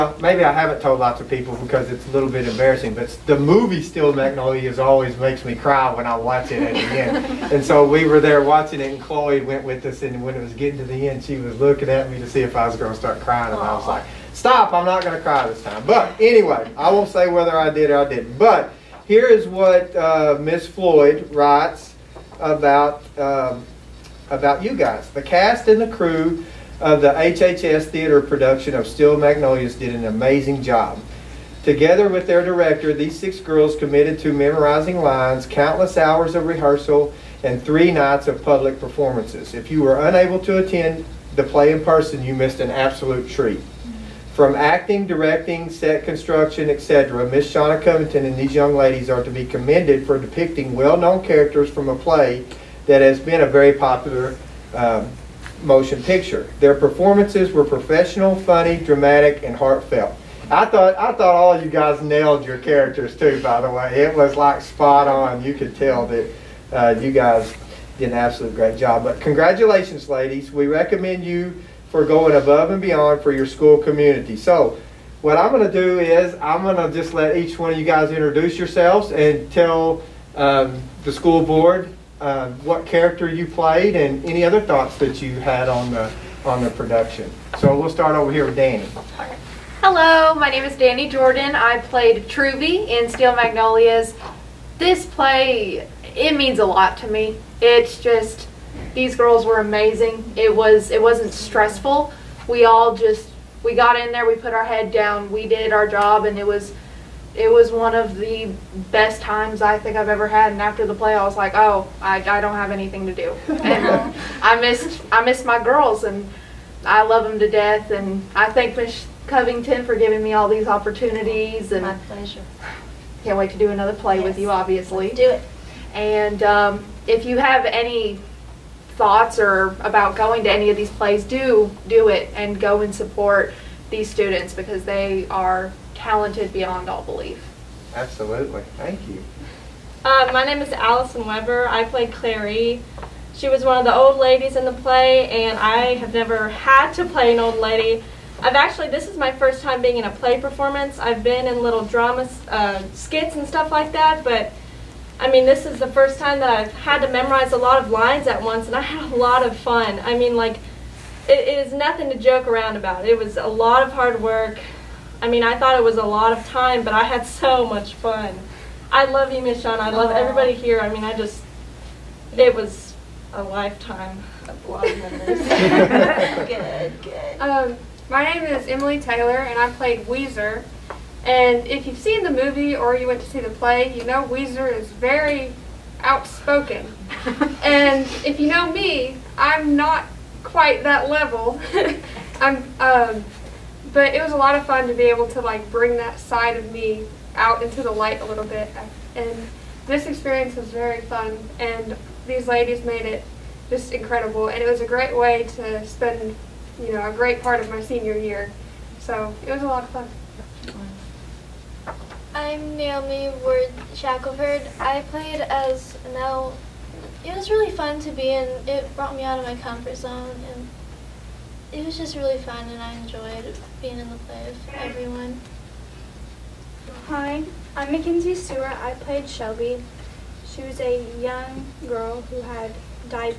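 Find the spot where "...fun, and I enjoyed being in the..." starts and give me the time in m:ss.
3:42.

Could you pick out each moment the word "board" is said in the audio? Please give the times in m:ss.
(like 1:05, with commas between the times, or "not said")
1:21.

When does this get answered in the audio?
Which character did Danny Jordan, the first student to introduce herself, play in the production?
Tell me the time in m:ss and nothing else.
1:32.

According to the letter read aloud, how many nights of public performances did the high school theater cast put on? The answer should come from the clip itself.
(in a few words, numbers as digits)
3.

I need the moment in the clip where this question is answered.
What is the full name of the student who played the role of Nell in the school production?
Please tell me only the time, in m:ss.
3:32.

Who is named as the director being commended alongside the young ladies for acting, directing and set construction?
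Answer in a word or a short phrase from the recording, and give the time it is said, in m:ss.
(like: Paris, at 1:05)
Shauna Covington, at 0:47.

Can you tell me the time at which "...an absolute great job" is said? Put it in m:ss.
1:08.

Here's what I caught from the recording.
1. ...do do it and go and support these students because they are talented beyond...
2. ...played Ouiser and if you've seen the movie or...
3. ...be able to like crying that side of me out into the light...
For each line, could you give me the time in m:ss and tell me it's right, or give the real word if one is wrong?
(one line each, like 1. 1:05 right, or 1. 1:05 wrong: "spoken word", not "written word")
1. 2:11 right
2. 2:59 right
3. 3:14 wrong: "bring", not "crying".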